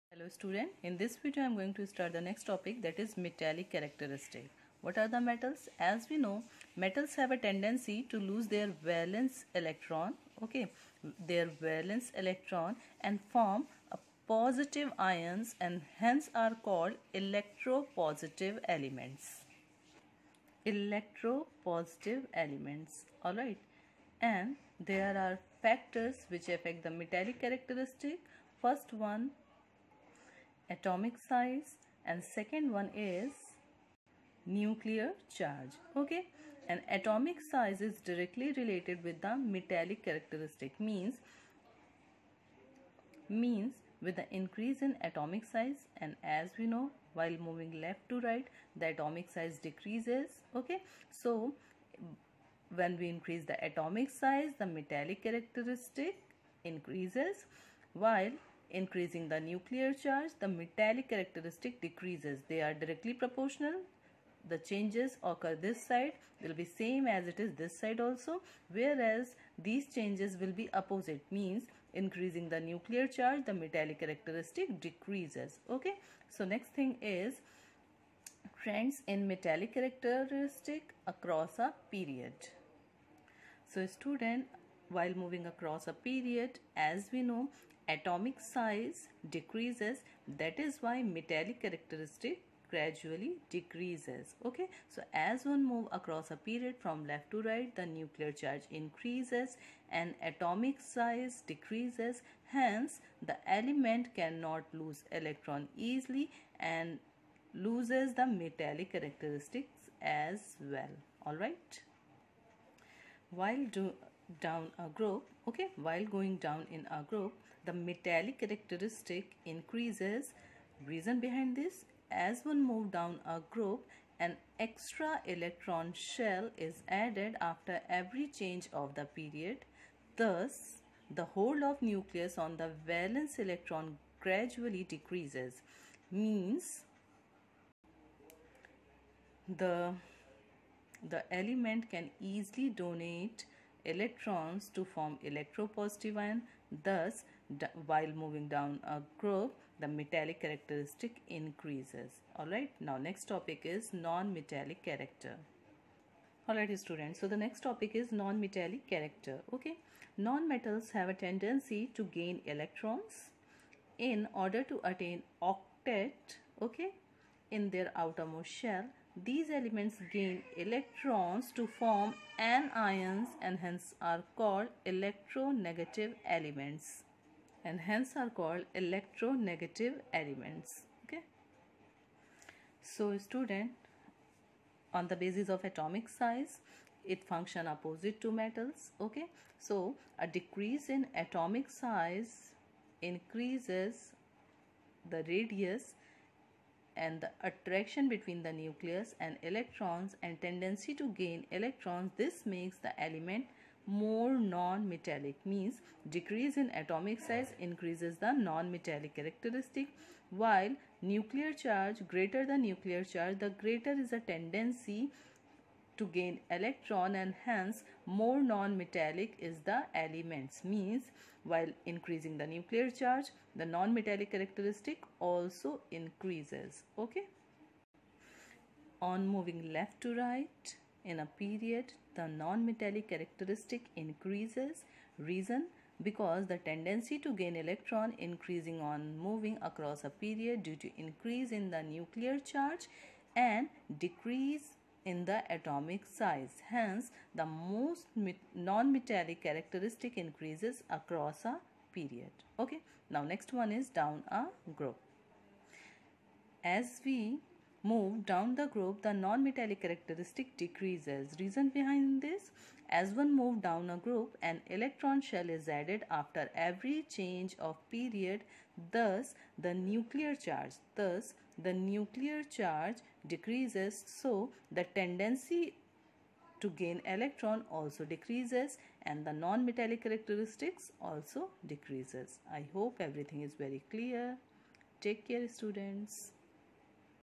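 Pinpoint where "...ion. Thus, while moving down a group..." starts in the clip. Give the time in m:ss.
2:26.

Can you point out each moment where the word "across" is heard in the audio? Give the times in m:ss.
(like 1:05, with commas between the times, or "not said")
1:21, 1:25, 1:35, 3:59, 4:10.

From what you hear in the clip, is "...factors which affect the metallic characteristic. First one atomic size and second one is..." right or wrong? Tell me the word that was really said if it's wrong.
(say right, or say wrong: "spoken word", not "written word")
right.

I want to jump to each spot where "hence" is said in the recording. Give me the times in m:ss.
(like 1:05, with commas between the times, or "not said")
0:15, 1:42, 2:53, 2:57, 3:37, 4:06.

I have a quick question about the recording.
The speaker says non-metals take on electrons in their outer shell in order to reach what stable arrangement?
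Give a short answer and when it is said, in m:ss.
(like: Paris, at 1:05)
octet, at 2:45.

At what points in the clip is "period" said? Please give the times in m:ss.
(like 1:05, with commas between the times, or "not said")
1:21, 1:25, 1:36, 2:09, 3:51, 4:00, 4:11, 4:27.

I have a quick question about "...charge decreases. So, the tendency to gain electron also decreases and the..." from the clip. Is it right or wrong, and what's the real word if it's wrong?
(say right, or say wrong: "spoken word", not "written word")
right.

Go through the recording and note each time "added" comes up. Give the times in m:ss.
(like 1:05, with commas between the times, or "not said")
2:06, 4:25.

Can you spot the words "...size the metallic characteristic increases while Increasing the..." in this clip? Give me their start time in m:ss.
0:54.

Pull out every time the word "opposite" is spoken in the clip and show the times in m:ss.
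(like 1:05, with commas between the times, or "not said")
1:10, 3:07.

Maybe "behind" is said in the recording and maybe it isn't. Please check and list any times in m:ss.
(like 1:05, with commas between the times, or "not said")
2:01, 4:21.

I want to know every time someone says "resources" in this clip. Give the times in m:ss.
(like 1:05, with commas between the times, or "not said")
not said.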